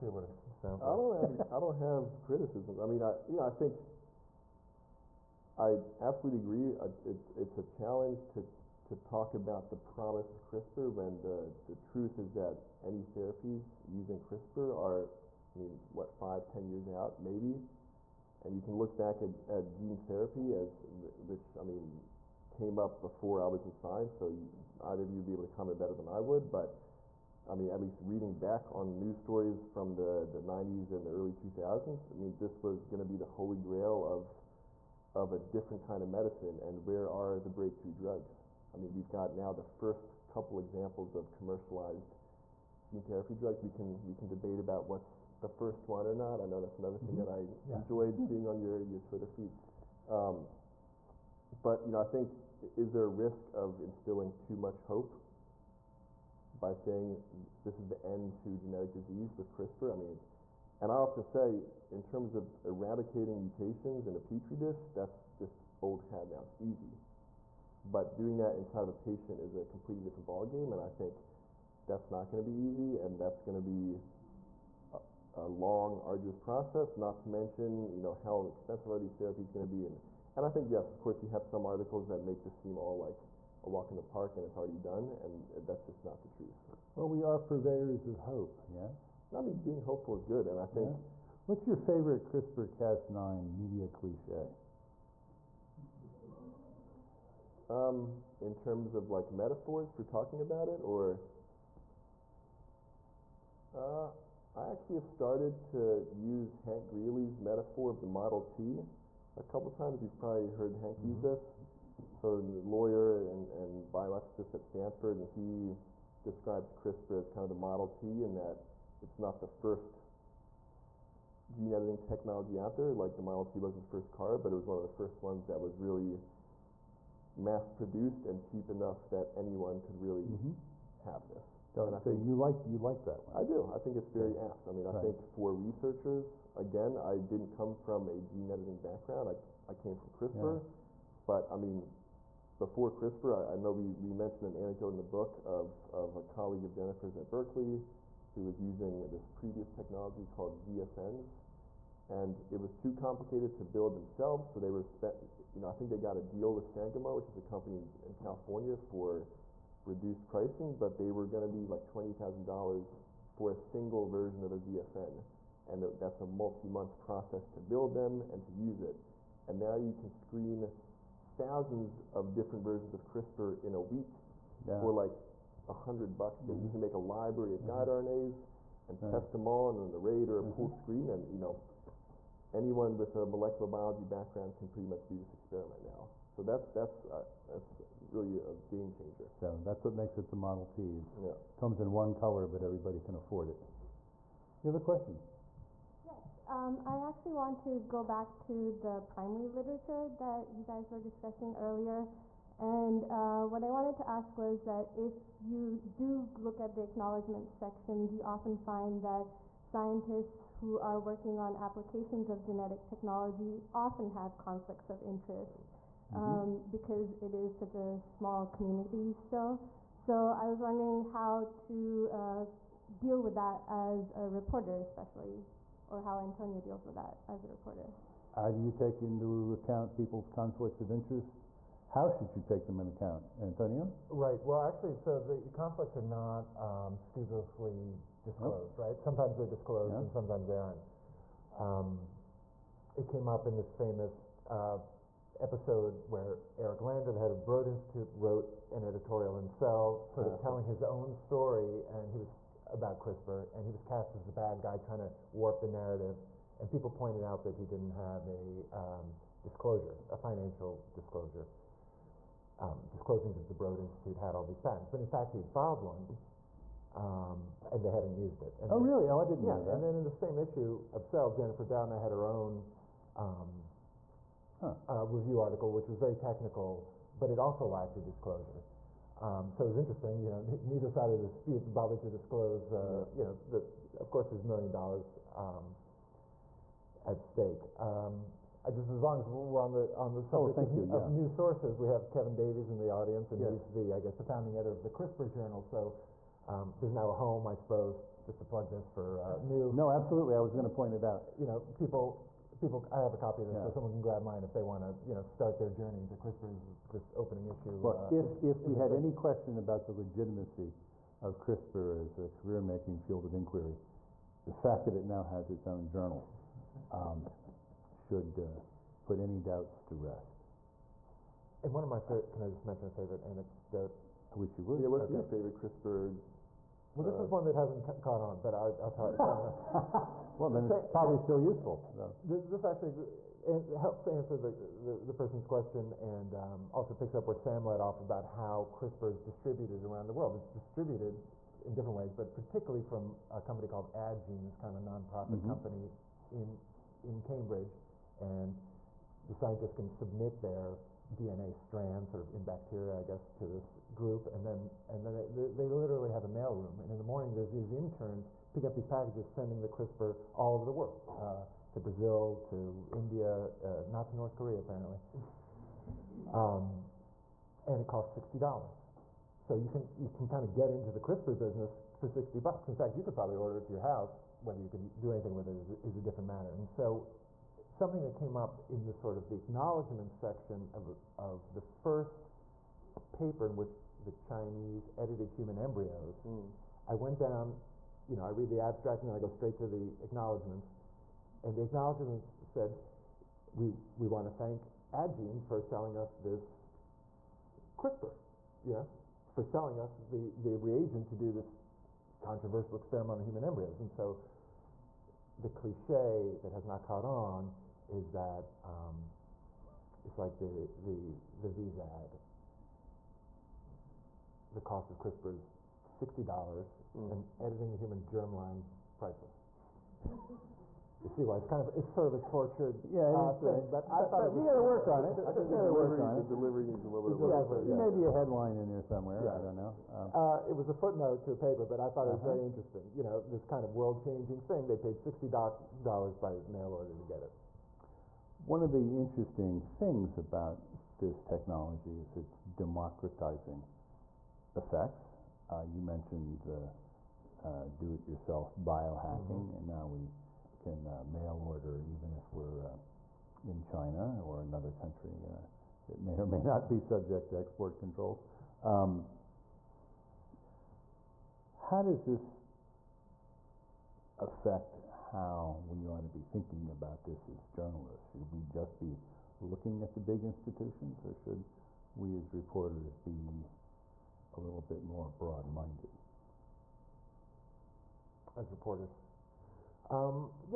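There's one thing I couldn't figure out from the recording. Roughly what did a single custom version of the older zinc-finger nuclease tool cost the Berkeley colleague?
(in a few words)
$20,000.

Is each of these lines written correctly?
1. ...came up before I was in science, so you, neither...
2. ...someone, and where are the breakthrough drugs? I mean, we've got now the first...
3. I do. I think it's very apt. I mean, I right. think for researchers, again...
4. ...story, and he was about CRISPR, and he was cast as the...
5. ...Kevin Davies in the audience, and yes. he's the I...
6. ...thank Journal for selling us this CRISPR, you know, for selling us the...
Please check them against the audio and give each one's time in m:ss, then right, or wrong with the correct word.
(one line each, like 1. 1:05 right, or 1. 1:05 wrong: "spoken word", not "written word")
1. 0:22 wrong: "either", not "neither"
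2. 0:36 wrong: "medicine", not "someone"
3. 2:13 right
4. 4:11 right
5. 4:52 right
6. 6:34 wrong: "Addgene", not "Journal".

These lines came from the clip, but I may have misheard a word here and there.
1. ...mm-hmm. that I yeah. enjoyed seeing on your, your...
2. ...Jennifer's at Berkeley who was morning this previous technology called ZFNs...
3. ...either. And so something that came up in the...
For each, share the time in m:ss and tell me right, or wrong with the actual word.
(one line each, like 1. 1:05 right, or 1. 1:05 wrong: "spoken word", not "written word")
1. 0:47 right
2. 2:26 wrong: "using", not "morning"
3. 6:16 wrong: "matter", not "either".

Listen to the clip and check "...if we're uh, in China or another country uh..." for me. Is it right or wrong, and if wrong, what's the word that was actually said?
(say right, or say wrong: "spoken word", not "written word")
right.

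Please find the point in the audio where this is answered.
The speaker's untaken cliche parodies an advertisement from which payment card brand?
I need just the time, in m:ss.
6:51.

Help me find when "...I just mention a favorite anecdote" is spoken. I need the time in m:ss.
5:22.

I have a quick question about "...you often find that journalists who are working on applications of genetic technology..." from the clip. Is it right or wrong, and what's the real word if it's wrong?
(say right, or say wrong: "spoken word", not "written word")
wrong: "scientists", not "journalists".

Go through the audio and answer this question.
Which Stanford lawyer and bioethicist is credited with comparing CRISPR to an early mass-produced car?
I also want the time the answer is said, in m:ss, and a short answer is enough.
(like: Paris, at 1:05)
Hank Greeley, at 1:46.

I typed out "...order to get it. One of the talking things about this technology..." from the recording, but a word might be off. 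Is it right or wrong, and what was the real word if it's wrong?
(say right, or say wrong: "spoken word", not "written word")
wrong: "interesting", not "talking".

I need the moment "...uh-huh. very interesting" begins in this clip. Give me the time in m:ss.
7:12.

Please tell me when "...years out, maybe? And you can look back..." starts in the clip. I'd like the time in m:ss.
0:16.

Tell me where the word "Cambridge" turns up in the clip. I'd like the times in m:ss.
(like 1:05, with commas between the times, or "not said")
5:47.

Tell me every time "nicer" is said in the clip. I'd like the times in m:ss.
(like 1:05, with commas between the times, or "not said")
not said.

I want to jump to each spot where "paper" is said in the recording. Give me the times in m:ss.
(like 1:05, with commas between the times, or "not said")
6:23, 7:11.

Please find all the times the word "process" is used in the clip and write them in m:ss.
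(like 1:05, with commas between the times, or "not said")
1:16, 2:46.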